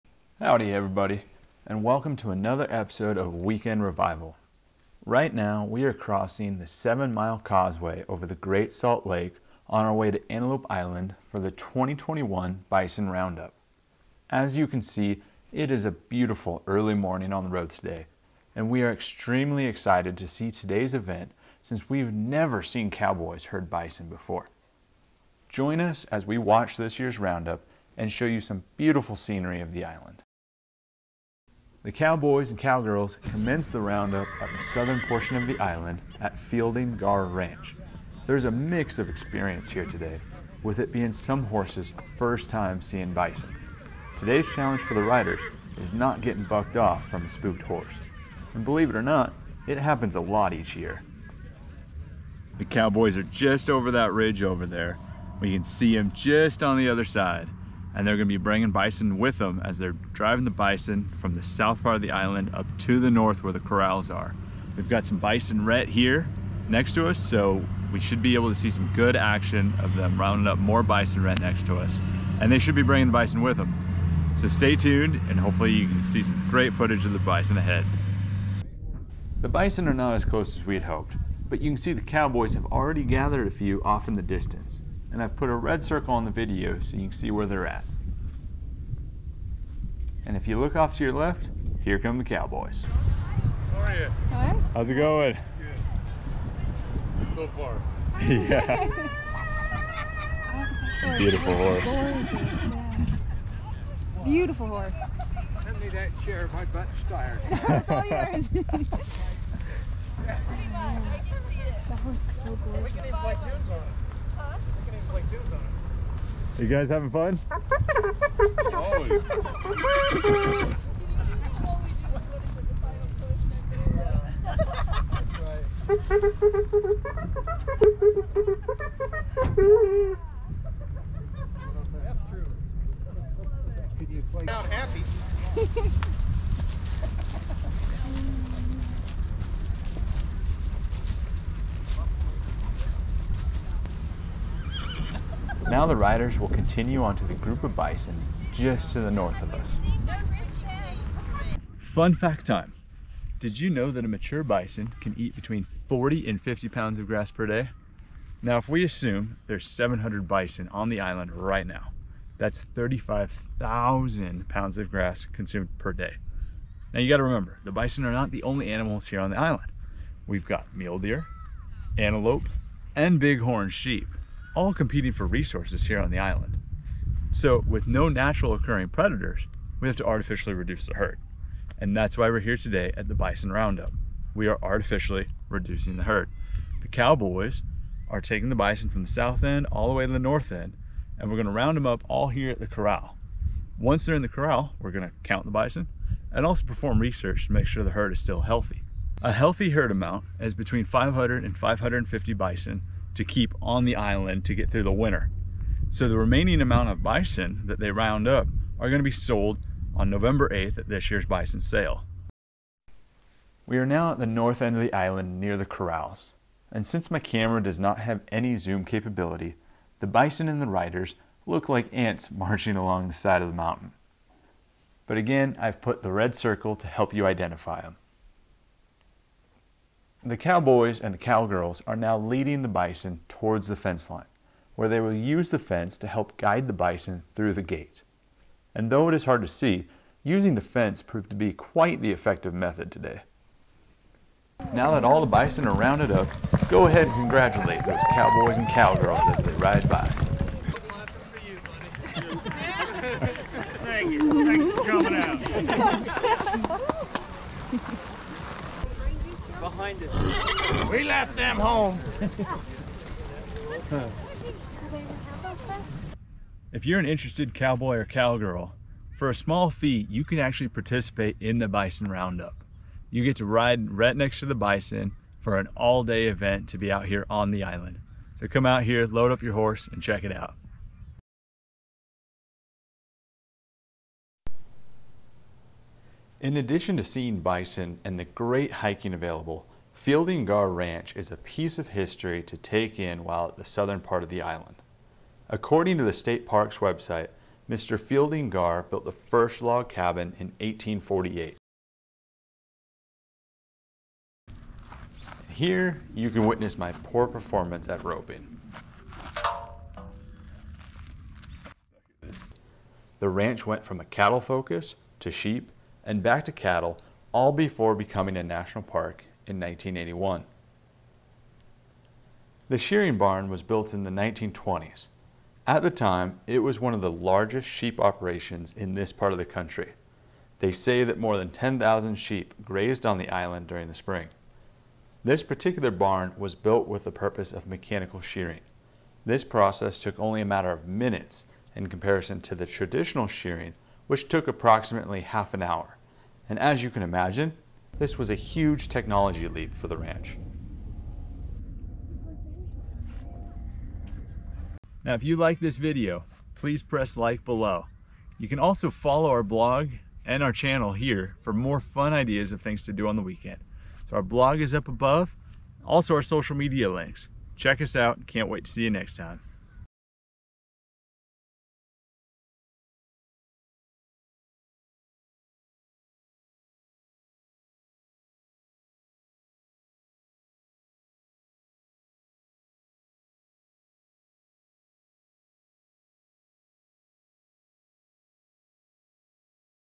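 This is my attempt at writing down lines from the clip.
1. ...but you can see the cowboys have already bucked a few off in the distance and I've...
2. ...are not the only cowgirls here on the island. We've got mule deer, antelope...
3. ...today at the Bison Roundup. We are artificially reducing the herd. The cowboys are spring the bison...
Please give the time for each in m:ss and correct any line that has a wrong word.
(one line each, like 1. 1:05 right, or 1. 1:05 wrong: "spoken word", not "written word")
1. 1:21 wrong: "gathered", not "bucked"
2. 2:48 wrong: "animals", not "cowgirls"
3. 3:02 wrong: "taking", not "spring".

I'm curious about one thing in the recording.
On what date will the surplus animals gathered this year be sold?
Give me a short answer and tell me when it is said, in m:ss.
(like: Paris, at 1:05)
November 8th, at 3:30.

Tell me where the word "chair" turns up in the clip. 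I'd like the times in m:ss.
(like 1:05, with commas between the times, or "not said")
1:46.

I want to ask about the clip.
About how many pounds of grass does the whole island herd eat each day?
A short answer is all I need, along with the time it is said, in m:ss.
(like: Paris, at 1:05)
35,000 pounds, at 2:42.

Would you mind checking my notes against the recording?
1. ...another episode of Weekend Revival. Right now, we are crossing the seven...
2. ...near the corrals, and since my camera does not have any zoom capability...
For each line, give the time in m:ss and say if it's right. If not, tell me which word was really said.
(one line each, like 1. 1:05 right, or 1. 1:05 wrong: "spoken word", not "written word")
1. 0:02 right
2. 3:35 right.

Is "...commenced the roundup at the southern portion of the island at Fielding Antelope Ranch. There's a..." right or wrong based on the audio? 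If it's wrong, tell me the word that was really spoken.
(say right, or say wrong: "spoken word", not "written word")
wrong: "Garr", not "Antelope".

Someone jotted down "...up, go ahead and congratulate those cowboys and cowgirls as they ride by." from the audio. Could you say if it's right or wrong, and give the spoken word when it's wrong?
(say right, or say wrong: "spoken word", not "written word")
right.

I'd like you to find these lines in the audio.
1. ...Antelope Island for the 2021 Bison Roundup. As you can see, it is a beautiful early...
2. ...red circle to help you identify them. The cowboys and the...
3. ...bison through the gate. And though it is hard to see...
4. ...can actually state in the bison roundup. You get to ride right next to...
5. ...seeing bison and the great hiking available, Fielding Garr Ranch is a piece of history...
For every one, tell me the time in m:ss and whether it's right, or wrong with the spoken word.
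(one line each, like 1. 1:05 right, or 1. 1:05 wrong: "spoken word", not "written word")
1. 0:10 right
2. 3:46 right
3. 3:56 right
4. 4:30 wrong: "participate", not "state"
5. 4:47 right.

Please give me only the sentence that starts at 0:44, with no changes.
Today's challenge for the riders is not getting bucked off from a spooked horse.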